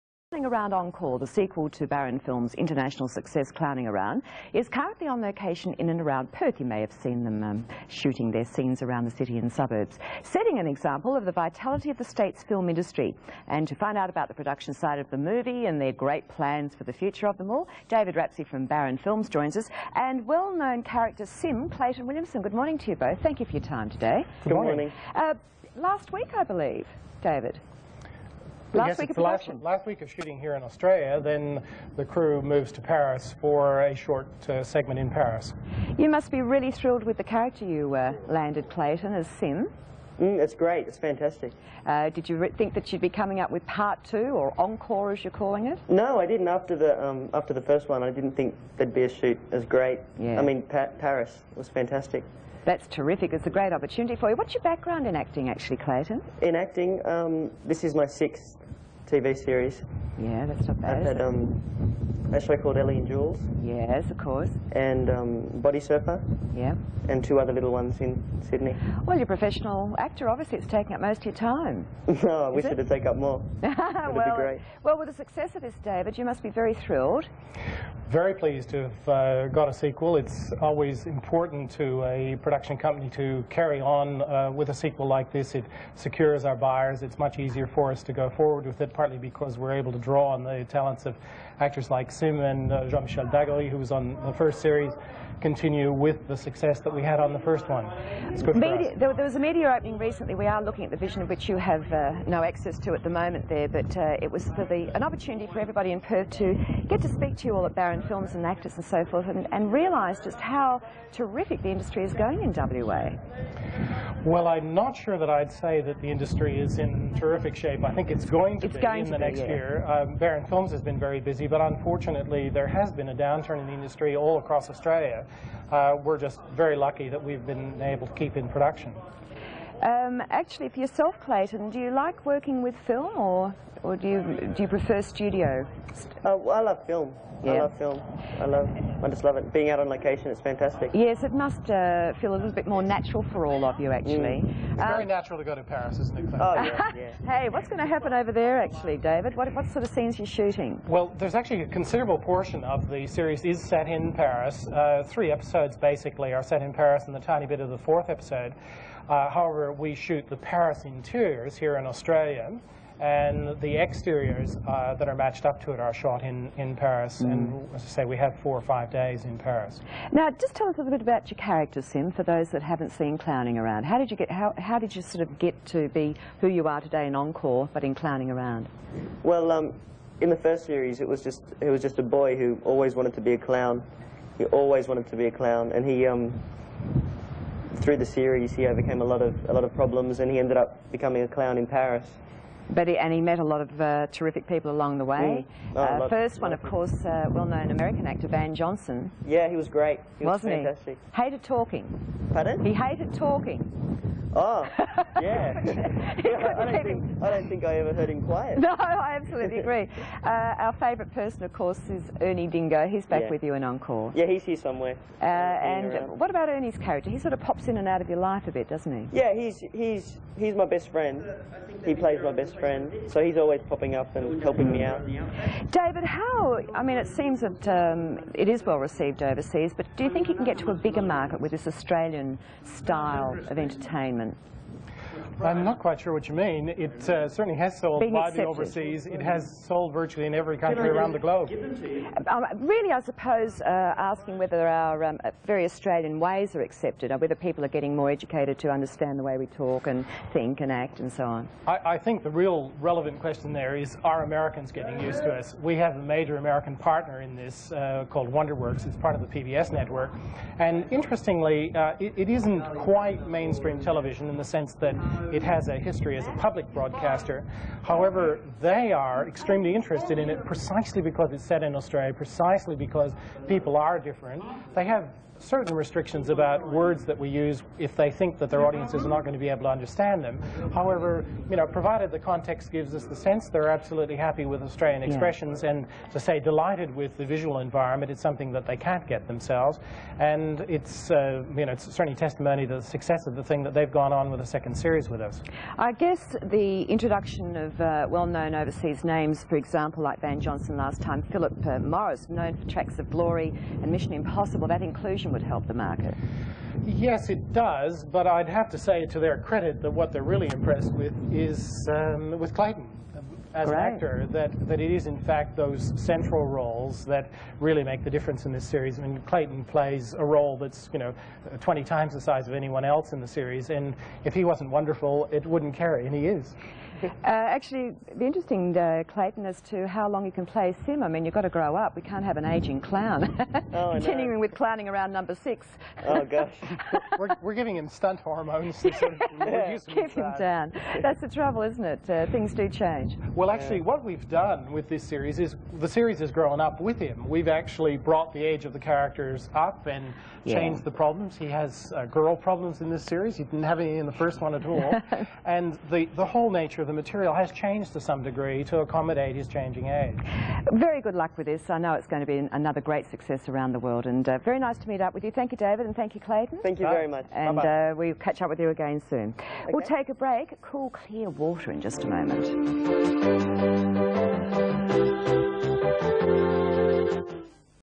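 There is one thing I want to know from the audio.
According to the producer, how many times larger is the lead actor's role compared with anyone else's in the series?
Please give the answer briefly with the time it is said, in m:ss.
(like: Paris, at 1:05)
20, at 5:21.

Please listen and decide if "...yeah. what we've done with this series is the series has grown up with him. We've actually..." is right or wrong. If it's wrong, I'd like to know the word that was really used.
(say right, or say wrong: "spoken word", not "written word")
right.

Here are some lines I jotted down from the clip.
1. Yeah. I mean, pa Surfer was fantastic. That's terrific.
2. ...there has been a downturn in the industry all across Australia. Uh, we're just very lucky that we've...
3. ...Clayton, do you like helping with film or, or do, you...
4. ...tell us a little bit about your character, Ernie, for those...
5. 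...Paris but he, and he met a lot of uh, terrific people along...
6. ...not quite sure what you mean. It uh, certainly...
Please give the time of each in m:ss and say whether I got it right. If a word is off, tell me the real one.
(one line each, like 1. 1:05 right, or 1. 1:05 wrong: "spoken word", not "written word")
1. 0:50 wrong: "Paris", not "Surfer"
2. 2:02 right
3. 2:11 wrong: "working", not "helping"
4. 2:50 wrong: "Sim", not "Ernie"
5. 3:11 right
6. 3:55 right.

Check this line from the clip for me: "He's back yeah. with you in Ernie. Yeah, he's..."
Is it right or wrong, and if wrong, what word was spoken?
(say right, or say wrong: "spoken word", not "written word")
wrong: "Encore", not "Ernie".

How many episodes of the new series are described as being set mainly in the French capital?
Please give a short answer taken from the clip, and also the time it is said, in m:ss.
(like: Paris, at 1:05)
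3, at 2:35.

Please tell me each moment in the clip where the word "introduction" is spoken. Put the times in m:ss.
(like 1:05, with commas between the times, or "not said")
4:56.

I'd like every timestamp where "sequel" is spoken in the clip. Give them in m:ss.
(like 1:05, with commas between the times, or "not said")
0:01, 1:19, 1:24.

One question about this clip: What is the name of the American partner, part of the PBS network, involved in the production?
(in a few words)
WonderWorks.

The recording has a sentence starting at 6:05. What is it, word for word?
Thank you, David, and thank you, Clayton.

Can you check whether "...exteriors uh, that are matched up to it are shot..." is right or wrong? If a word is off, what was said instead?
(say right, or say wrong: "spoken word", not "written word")
right.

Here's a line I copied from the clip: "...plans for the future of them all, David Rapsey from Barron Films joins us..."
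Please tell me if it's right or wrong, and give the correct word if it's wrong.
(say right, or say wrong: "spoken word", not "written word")
right.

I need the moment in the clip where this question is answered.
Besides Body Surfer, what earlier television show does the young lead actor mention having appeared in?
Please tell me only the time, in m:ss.
1:02.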